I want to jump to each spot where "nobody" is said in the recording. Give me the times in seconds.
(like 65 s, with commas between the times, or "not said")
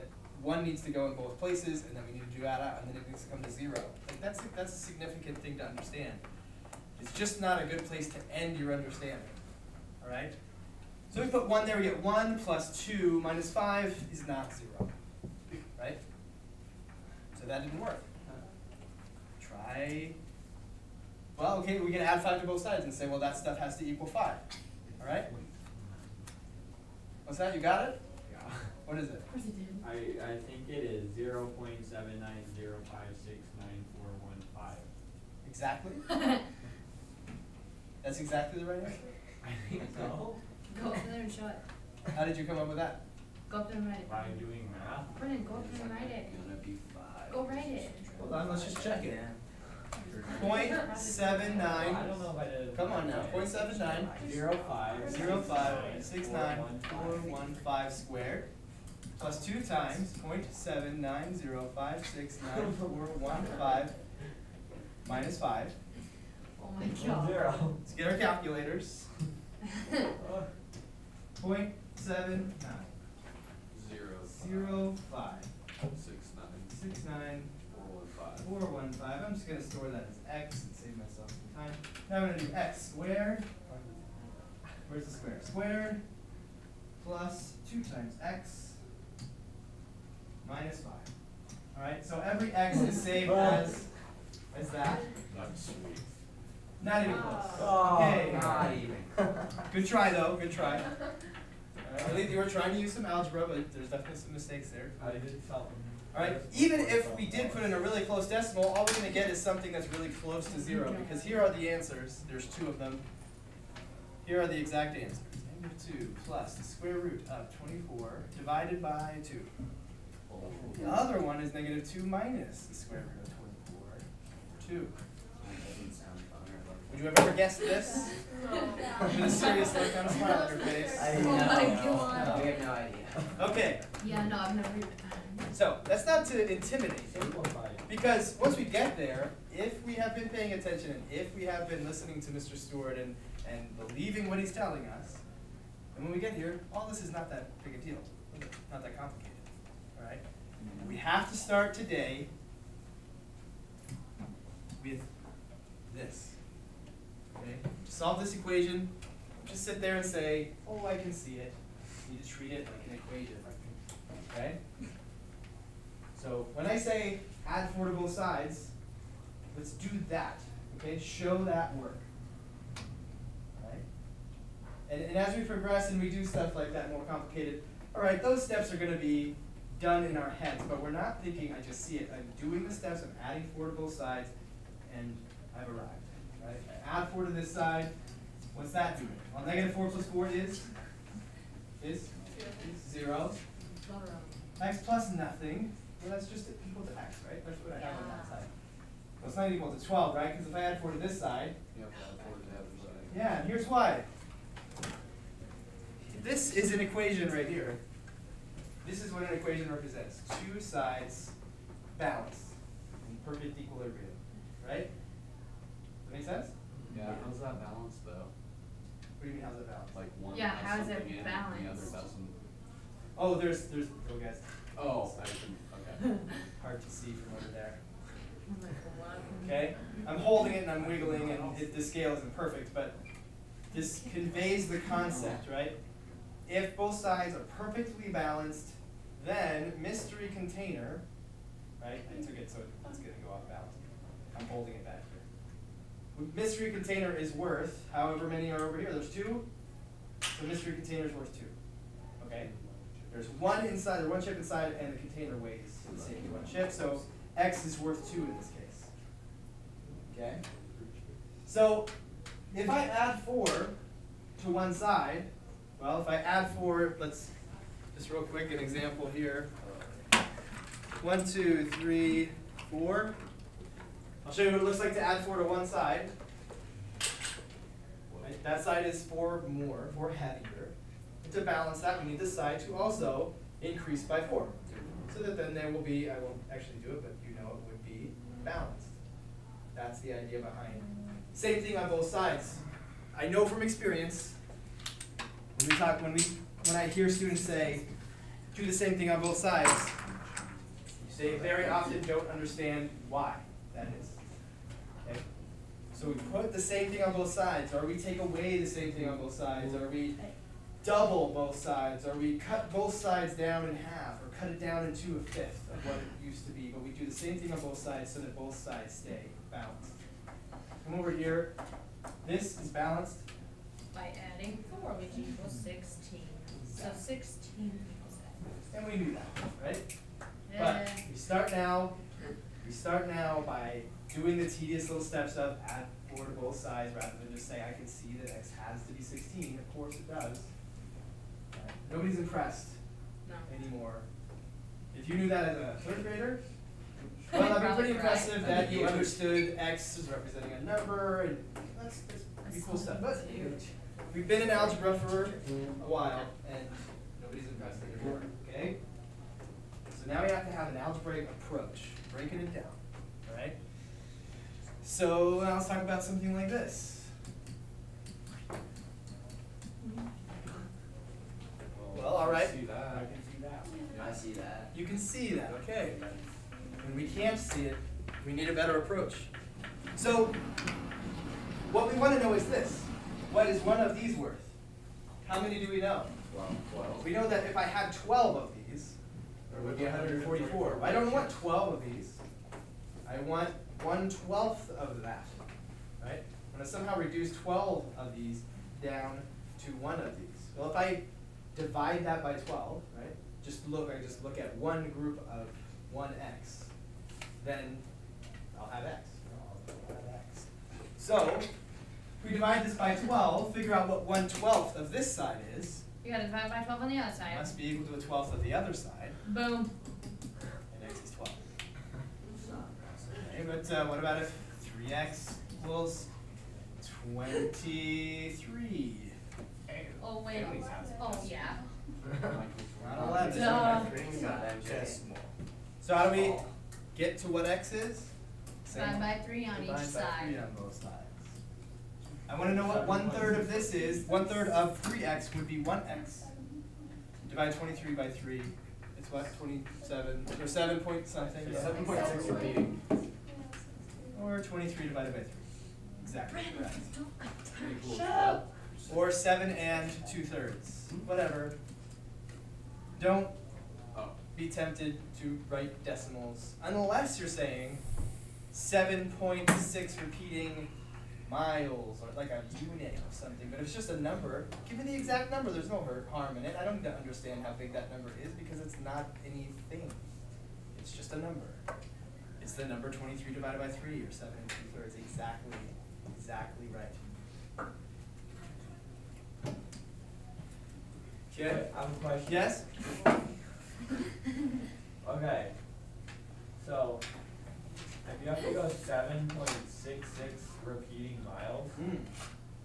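341 s, 357 s.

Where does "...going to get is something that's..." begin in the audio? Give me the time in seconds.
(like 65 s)
108 s.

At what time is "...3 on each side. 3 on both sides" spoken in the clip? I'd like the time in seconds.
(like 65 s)
439 s.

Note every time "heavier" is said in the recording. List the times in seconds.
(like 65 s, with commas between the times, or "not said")
280 s.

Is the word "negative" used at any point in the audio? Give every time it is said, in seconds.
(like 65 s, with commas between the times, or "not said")
115 s, 121 s, 189 s.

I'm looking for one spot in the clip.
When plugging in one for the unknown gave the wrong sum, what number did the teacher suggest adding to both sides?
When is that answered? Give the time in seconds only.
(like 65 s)
21 s.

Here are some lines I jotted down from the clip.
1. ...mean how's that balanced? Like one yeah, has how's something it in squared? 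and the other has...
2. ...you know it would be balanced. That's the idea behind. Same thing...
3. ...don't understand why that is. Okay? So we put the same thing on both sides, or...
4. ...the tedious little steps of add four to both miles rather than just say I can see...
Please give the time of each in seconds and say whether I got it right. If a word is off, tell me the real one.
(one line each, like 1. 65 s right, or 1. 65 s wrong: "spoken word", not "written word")
1. 219 s wrong: "balanced", not "squared"
2. 287 s right
3. 302 s right
4. 334 s wrong: "sides", not "miles".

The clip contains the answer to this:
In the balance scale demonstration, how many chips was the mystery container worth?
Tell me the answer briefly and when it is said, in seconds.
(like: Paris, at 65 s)
2, at 250 s.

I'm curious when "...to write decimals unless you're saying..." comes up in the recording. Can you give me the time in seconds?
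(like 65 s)
465 s.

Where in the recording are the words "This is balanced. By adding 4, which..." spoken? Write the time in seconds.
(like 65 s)
322 s.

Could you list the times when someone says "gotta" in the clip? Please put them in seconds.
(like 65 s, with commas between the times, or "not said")
416 s.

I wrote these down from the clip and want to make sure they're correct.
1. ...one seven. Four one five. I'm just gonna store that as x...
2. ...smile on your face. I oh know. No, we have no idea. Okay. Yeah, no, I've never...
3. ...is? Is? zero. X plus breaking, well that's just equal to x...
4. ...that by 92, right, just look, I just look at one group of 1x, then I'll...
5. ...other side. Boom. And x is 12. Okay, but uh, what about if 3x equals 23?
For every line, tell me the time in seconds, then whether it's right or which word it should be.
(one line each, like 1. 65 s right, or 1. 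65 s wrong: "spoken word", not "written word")
1. 74 s wrong: "five", not "seven"
2. 130 s right
3. 190 s wrong: "nothing", not "breaking"
4. 402 s wrong: "12", not "92"
5. 418 s right.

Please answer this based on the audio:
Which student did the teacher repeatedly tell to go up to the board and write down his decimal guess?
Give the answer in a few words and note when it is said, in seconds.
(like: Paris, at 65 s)
Brennan, at 45 s.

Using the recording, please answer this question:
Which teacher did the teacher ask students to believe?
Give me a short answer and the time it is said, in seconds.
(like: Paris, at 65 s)
Mr. Stewart, at 142 s.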